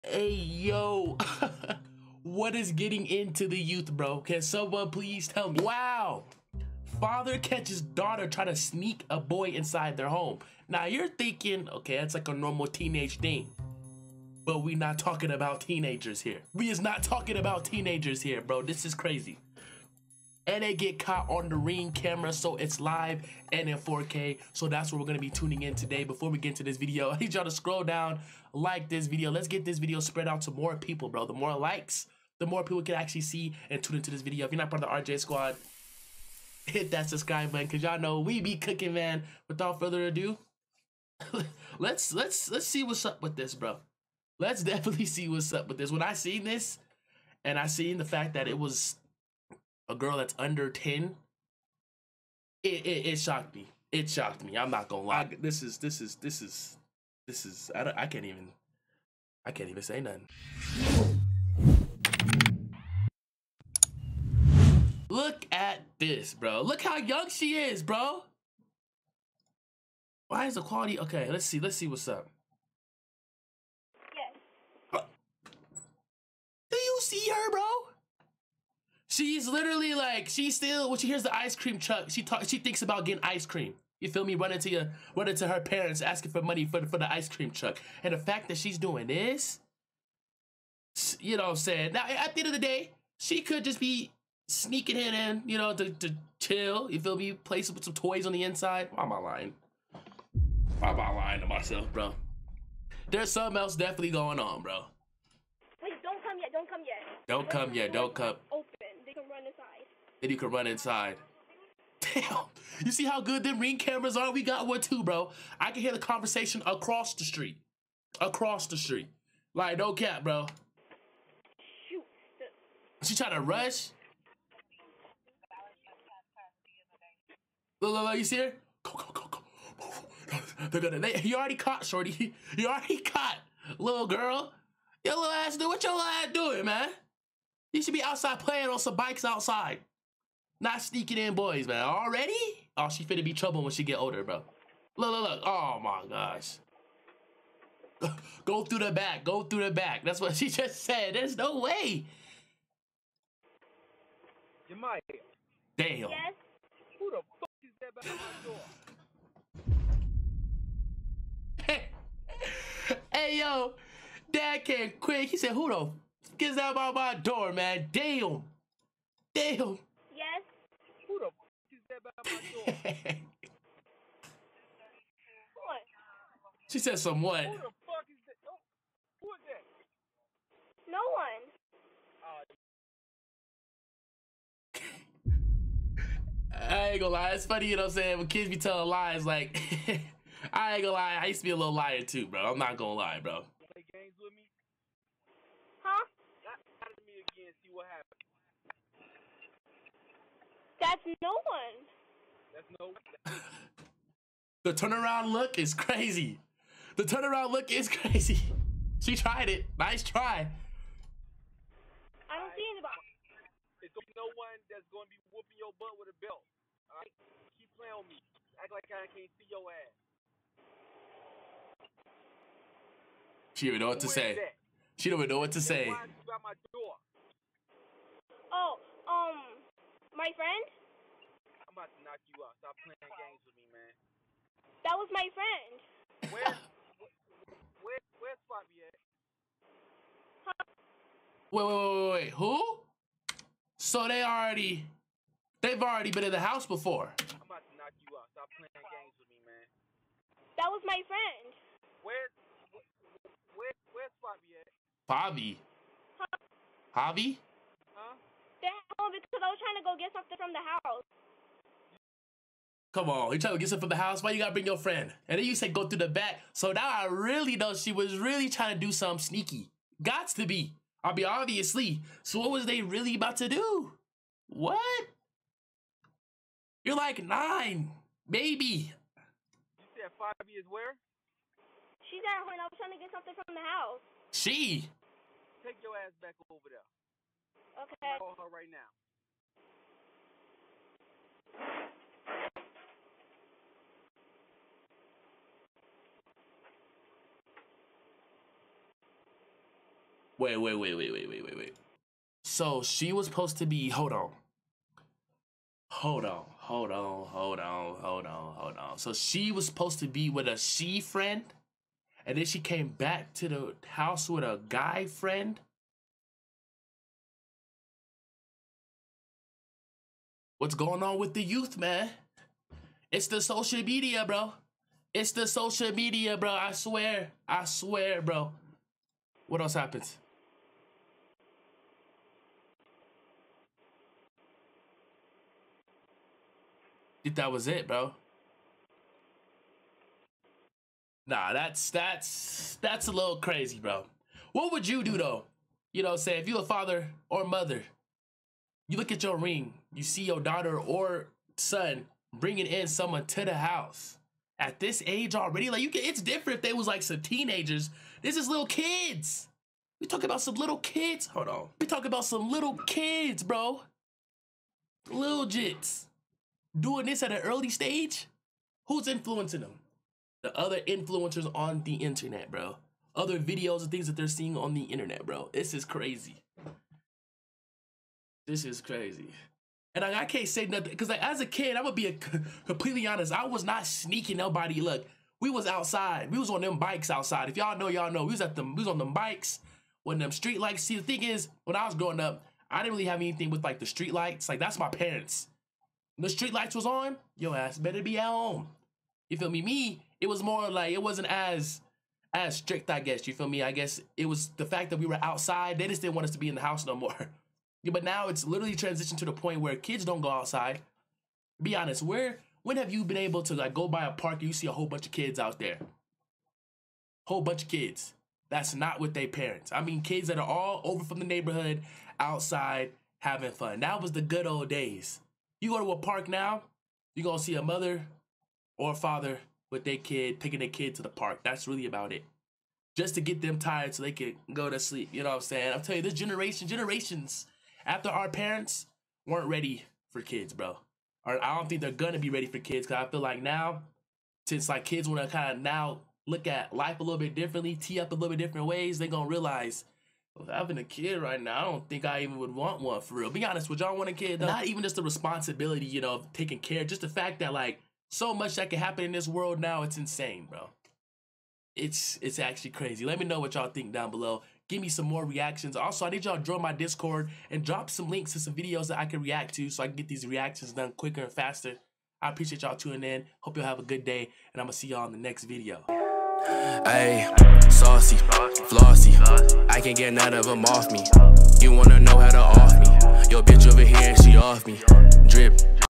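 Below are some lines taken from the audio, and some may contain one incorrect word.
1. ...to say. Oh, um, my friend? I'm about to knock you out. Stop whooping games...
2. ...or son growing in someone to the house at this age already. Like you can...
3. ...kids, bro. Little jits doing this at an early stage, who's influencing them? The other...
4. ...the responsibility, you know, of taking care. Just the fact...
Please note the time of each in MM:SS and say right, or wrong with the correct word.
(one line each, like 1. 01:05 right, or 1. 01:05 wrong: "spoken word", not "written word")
1. 03:45 wrong: "playing", not "whooping"
2. 05:50 wrong: "bringing", not "growing"
3. 06:02 right
4. 07:34 right.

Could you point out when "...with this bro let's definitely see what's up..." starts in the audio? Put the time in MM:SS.
00:43.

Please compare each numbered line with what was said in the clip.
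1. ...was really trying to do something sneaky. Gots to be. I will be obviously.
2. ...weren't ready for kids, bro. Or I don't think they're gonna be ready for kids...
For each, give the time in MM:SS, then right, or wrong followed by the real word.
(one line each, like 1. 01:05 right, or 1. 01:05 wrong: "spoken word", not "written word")
1. 04:27 right
2. 07:19 right.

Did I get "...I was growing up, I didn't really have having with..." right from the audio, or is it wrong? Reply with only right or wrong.
wrong.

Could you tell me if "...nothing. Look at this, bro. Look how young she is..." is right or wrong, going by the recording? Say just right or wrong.
right.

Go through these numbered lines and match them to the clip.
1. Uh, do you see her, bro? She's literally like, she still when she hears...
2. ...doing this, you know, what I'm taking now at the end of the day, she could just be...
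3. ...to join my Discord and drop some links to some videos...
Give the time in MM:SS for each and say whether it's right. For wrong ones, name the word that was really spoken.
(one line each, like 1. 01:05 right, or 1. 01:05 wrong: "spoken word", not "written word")
1. 01:14 right
2. 01:28 wrong: "saying", not "taking"
3. 07:46 right.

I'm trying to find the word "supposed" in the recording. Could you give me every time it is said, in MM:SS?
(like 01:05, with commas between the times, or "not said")
05:03, 05:09.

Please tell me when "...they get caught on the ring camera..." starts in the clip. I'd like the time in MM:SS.
00:20.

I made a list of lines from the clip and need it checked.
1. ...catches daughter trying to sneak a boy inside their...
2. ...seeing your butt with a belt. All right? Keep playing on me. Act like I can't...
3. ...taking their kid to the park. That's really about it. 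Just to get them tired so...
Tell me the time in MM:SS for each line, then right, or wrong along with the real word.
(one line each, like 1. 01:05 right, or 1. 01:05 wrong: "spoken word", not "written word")
1. 00:07 right
2. 03:35 wrong: "whooping", not "seeing"
3. 07:10 right.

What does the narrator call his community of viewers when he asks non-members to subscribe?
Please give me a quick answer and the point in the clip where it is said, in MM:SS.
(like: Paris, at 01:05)
RJ squad, at 00:35.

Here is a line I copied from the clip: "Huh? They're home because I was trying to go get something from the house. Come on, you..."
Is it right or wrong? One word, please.
right.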